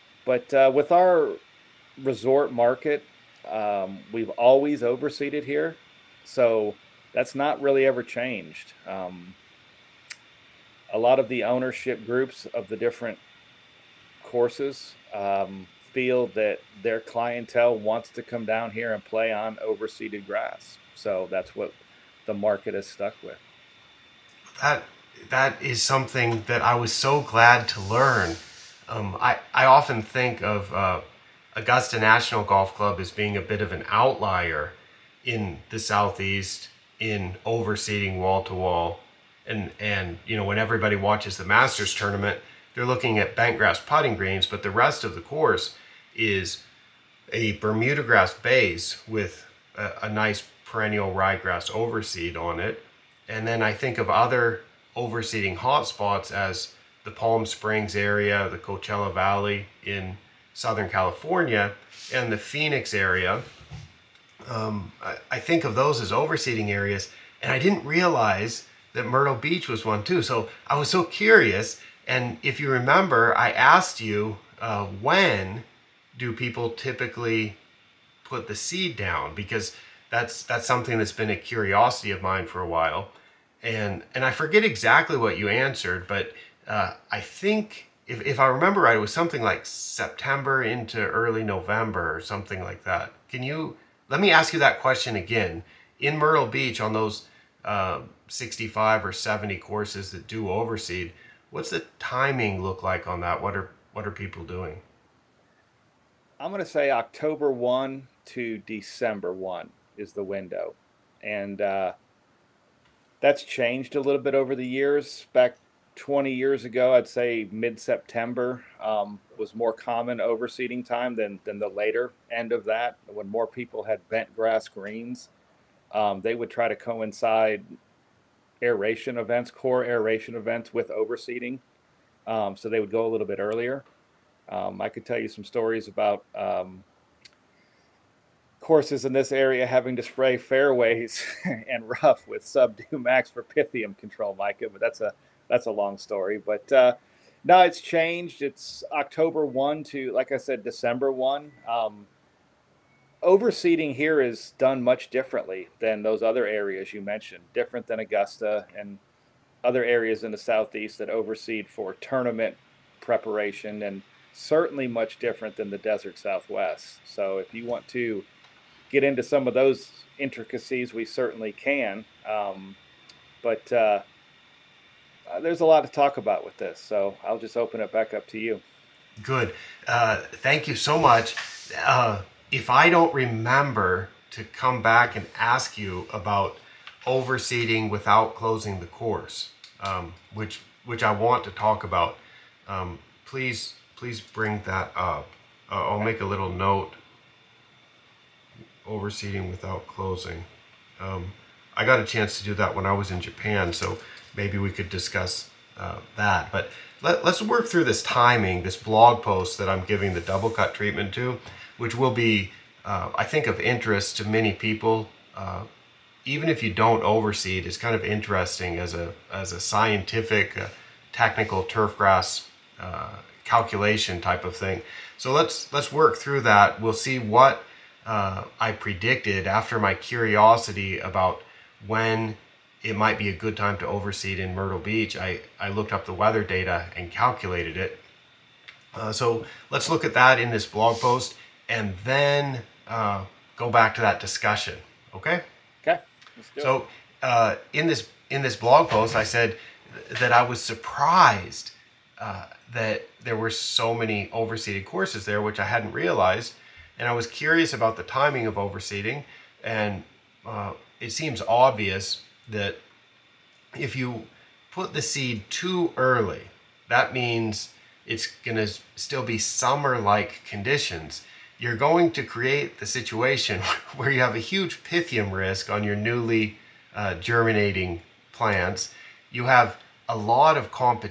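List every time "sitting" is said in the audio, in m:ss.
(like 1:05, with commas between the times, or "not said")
not said.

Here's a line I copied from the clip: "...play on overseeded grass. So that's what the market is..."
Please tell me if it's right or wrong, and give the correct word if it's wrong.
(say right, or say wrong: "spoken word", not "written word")
right.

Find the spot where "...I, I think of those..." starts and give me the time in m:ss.
1:05.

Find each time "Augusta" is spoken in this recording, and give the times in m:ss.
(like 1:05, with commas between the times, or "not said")
0:31, 2:37.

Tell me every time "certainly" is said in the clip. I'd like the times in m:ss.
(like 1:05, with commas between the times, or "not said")
2:44, 2:51.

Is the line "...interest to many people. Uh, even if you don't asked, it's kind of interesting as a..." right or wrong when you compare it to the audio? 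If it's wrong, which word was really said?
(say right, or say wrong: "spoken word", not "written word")
wrong: "overseed", not "asked".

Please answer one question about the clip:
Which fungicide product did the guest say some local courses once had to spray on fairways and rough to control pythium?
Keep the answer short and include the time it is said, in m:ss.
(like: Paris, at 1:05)
Subdue MAXX, at 2:22.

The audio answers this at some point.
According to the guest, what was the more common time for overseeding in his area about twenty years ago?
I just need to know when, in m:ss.
1:57.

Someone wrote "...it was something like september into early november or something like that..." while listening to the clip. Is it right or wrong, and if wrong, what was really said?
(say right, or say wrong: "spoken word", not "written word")
right.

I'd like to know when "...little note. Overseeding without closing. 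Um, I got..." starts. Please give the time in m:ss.
3:16.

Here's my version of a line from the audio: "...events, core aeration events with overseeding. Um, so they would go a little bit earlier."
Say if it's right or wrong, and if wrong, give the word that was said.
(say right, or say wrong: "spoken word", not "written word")
right.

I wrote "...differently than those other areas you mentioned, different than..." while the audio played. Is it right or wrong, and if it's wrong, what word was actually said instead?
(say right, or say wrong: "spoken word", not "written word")
right.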